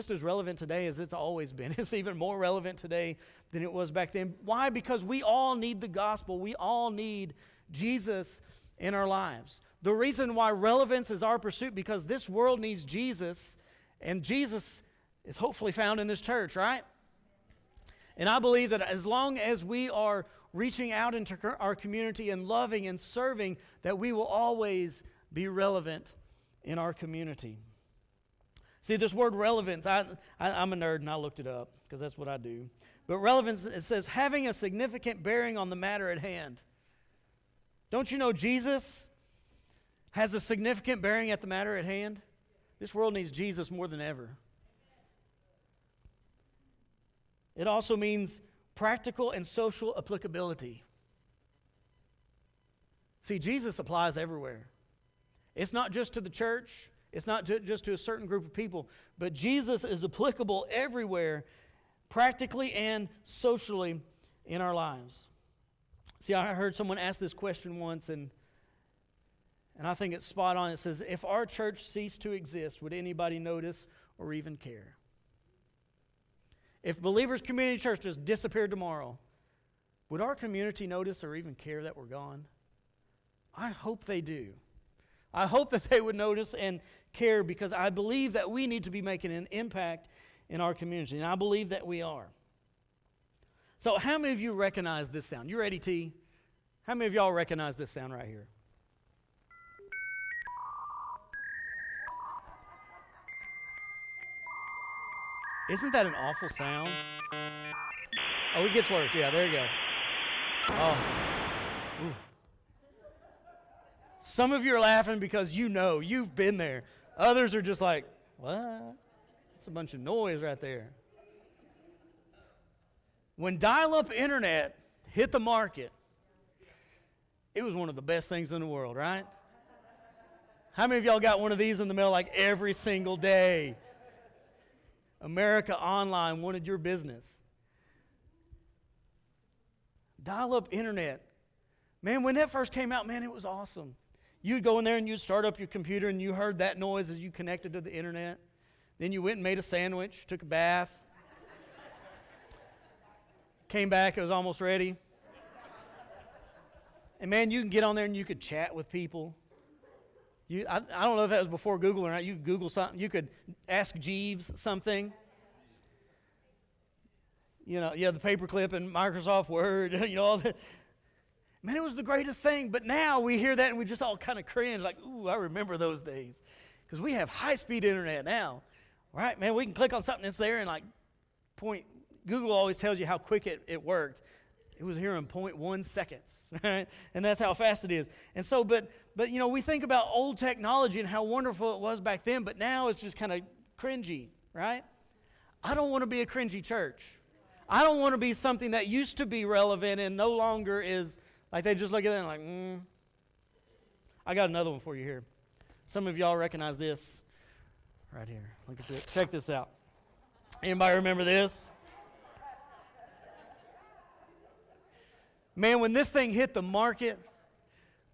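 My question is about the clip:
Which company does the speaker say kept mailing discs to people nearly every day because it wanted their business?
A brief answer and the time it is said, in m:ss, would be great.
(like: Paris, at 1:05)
America Online, at 2:15.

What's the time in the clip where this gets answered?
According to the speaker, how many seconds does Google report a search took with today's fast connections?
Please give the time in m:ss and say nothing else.
3:05.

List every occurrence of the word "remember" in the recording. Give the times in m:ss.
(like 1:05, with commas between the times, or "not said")
2:55, 3:30.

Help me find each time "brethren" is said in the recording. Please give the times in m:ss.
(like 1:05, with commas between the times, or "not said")
not said.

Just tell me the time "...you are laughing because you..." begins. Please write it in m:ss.
1:54.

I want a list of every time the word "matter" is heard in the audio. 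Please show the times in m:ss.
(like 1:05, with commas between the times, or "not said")
0:35, 0:41.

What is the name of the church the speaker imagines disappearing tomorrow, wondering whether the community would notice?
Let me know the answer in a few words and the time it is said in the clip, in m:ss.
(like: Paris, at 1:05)
Believers Community Church, at 1:17.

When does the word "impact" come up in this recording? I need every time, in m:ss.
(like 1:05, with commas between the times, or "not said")
1:29.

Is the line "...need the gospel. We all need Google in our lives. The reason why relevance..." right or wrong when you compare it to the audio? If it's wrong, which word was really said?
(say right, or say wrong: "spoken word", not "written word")
wrong: "Jesus", not "Google".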